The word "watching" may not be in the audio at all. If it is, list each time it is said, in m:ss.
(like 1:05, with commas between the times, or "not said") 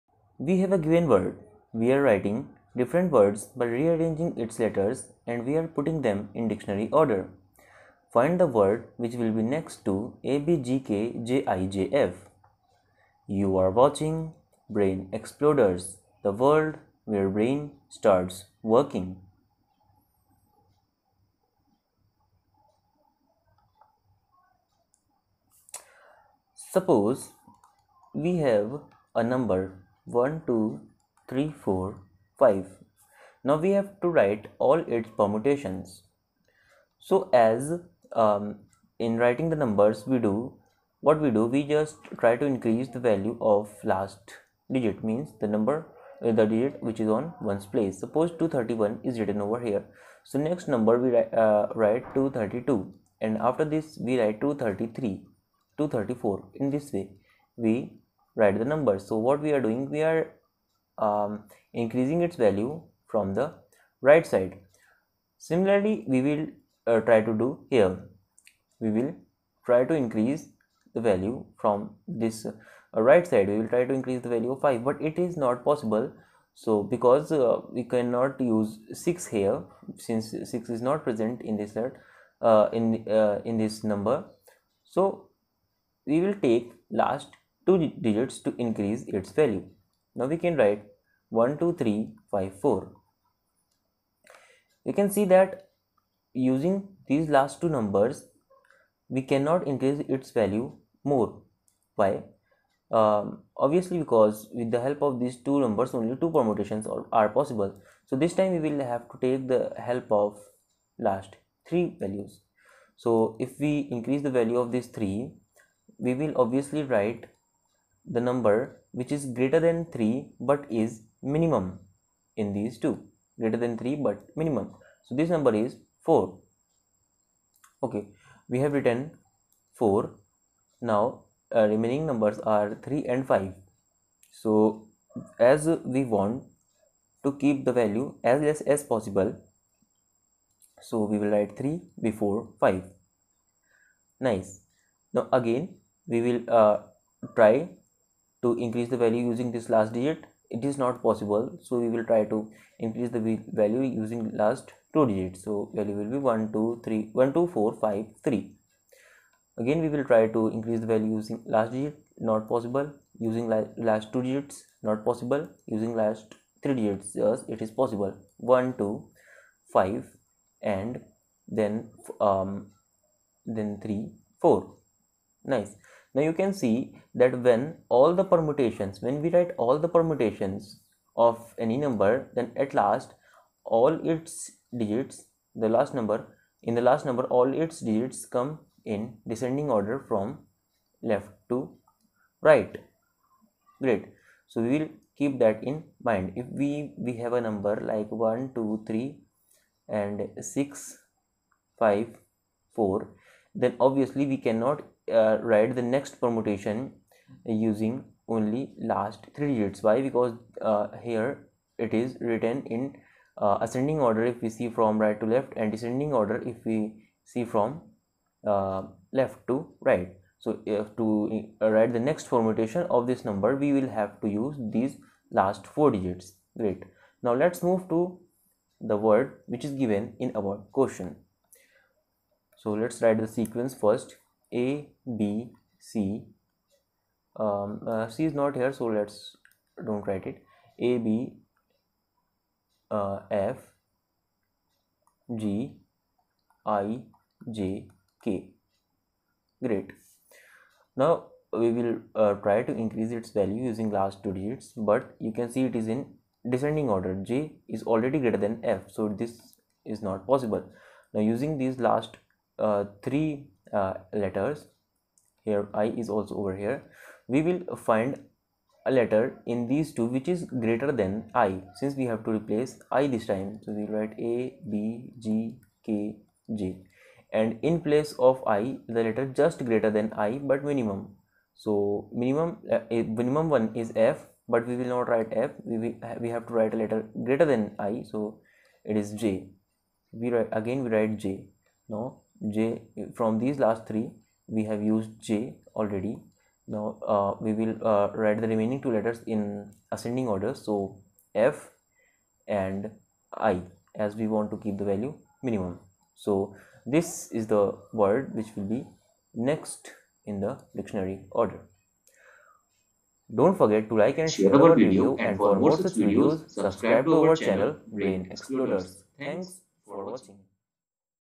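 0:13, 5:20.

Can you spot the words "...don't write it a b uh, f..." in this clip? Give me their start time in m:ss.
3:59.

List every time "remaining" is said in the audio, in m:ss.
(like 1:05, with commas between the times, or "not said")
2:11, 4:58.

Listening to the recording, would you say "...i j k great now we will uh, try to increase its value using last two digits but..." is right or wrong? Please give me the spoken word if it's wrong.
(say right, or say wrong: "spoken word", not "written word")
right.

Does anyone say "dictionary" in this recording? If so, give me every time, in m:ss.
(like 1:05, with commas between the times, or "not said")
0:06, 5:10.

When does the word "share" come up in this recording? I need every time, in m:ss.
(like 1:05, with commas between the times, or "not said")
5:14.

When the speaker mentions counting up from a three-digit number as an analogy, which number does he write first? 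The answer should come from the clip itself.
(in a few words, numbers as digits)
231.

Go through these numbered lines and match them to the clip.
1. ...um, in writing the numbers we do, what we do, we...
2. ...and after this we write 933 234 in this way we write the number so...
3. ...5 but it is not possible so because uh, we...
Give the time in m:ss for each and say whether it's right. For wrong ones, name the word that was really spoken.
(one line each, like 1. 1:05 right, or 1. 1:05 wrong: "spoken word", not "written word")
1. 0:38 right
2. 0:53 wrong: "233", not "933"
3. 1:14 right.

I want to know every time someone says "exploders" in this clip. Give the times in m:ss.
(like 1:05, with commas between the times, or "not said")
0:15, 5:18.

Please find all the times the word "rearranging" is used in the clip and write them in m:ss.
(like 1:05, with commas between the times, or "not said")
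0:03.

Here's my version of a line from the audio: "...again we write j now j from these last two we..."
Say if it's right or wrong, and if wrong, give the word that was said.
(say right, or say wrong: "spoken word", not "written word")
wrong: "three", not "two".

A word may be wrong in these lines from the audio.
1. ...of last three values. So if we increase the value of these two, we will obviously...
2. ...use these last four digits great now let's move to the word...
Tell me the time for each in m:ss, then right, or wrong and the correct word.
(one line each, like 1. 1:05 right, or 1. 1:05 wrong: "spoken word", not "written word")
1. 1:50 wrong: "three", not "two"
2. 3:44 right.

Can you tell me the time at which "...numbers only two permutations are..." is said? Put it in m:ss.
1:45.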